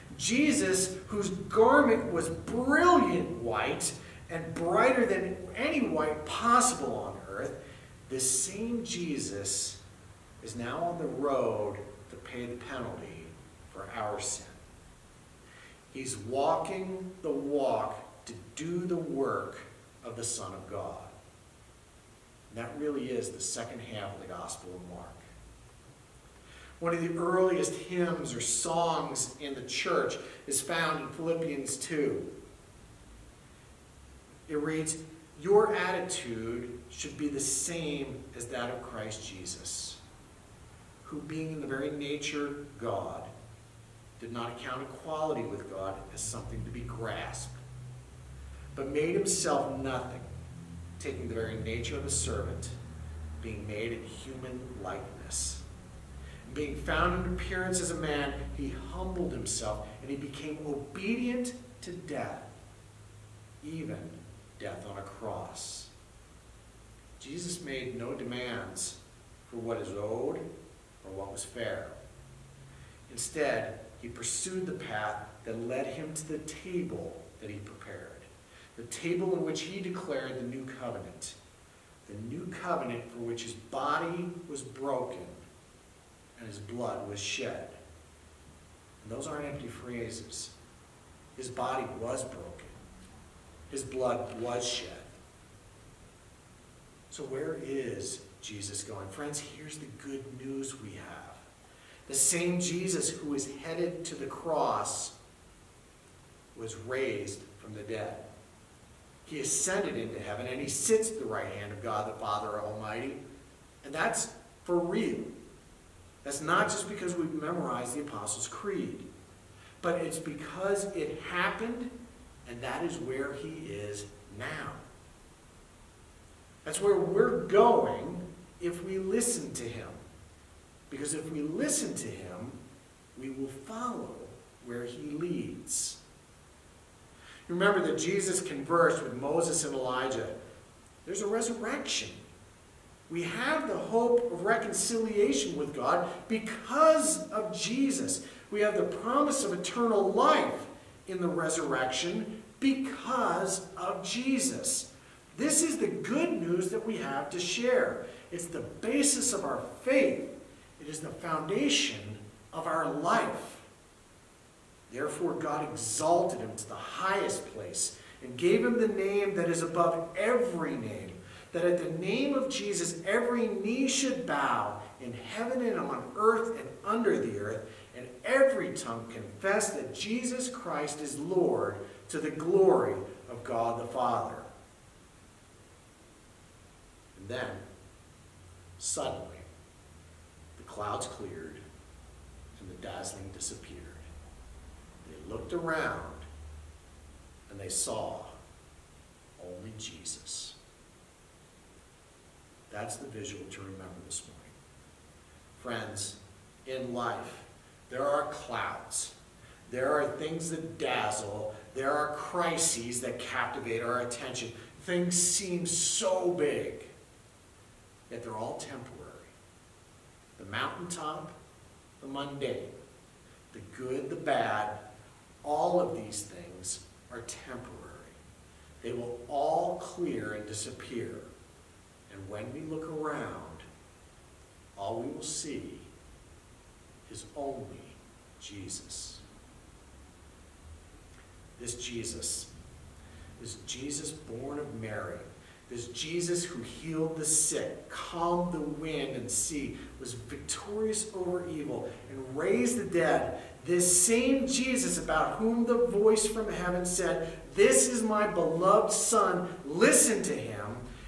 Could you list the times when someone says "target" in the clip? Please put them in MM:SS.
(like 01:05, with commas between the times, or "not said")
not said.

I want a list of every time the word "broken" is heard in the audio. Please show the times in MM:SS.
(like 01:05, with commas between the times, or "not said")
01:24, 01:32.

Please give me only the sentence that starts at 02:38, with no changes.
It's the basis of our faith.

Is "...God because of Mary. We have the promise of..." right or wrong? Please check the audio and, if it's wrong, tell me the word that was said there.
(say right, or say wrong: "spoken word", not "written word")
wrong: "Jesus", not "Mary".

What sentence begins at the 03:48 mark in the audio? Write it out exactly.
They will all clear and disappear.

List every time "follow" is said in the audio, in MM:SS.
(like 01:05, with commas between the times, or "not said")
02:13.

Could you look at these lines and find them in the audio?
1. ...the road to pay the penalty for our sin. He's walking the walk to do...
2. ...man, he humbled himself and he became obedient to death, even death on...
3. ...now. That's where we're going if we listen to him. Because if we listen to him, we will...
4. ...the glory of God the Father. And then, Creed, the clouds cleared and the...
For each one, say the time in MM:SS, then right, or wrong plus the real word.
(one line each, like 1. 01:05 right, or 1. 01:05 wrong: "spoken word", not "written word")
1. 00:10 right
2. 00:57 right
3. 02:04 right
4. 03:02 wrong: "Suddenly", not "Creed".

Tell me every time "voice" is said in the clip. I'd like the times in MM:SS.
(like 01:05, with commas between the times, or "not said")
04:15.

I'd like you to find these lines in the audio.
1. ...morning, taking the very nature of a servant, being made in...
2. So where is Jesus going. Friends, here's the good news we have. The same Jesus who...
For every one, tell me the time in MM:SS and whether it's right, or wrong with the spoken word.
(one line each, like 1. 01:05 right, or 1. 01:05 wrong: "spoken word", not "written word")
1. 00:49 wrong: "nothing", not "morning"
2. 01:37 right.